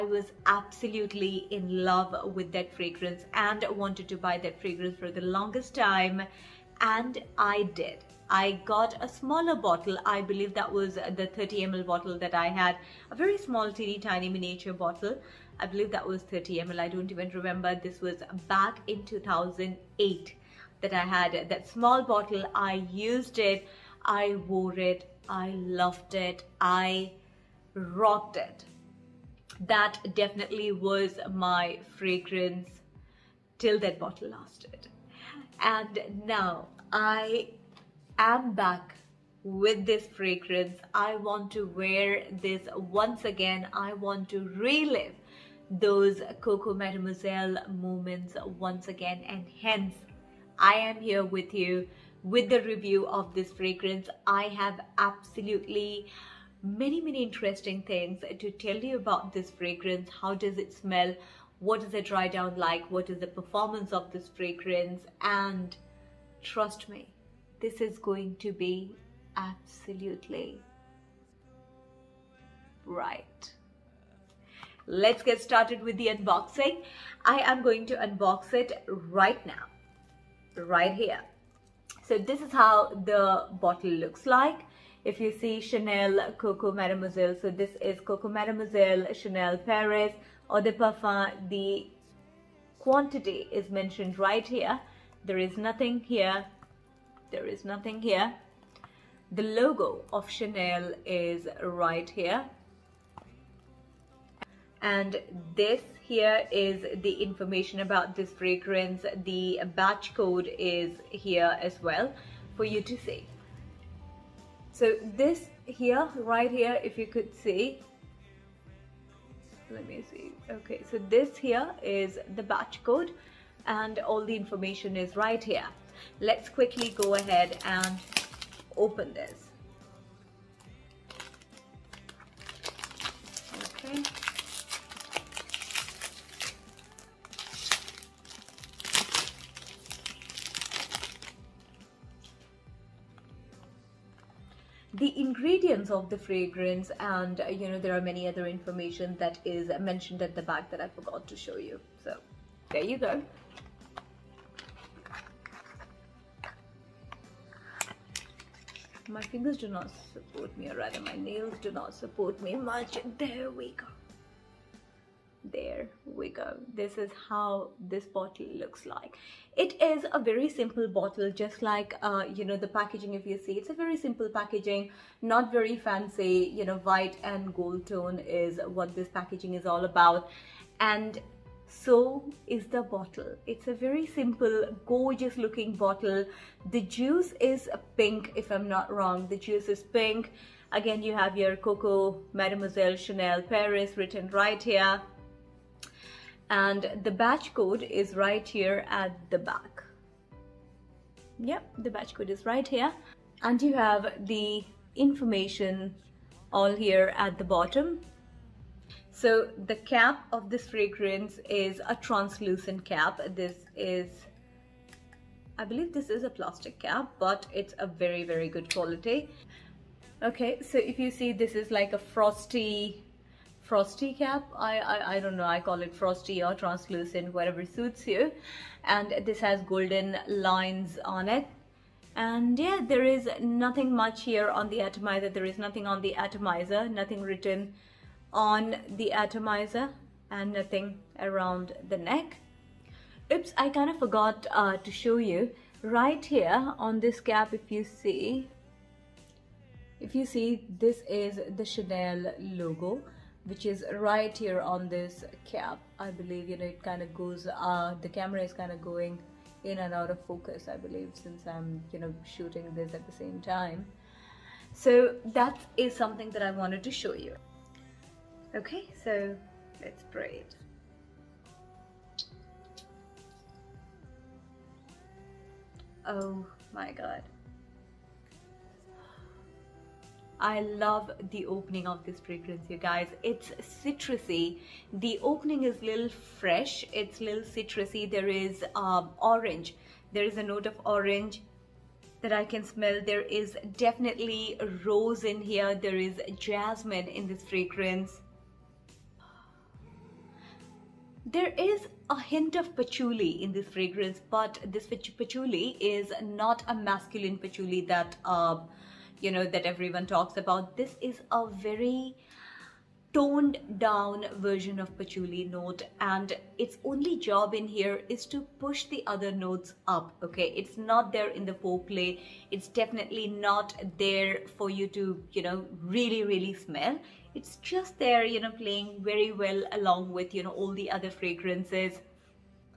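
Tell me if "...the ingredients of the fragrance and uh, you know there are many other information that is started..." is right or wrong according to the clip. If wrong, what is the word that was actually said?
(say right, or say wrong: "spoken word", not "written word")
wrong: "mentioned", not "started".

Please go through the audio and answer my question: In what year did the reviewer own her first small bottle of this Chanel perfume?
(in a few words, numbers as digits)
2008.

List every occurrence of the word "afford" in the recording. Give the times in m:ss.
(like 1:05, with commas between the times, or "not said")
not said.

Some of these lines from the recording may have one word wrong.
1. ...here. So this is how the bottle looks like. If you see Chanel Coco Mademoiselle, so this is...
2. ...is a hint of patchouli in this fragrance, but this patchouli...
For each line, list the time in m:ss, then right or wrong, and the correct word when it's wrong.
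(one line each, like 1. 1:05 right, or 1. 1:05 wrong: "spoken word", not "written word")
1. 1:20 right
2. 5:01 right.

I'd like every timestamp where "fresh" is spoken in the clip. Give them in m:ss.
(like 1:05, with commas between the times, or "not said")
4:46.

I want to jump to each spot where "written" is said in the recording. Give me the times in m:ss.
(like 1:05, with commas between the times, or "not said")
3:13, 3:57.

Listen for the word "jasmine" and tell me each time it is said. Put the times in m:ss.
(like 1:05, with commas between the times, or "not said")
4:56.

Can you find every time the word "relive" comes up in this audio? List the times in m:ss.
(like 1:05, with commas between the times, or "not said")
0:44.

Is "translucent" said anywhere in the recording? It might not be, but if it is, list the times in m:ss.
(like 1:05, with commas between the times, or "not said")
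3:31, 3:46.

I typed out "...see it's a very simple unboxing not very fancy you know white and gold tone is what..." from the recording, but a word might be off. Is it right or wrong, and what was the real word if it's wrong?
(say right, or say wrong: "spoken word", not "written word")
wrong: "packaging", not "unboxing".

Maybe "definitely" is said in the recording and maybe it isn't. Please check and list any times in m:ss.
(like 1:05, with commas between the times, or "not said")
0:30, 4:53, 5:22.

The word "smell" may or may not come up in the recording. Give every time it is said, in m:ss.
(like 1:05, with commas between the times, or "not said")
1:00, 4:52, 5:26.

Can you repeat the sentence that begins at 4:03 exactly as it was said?
Oops, I kind of forgot uh, to show you.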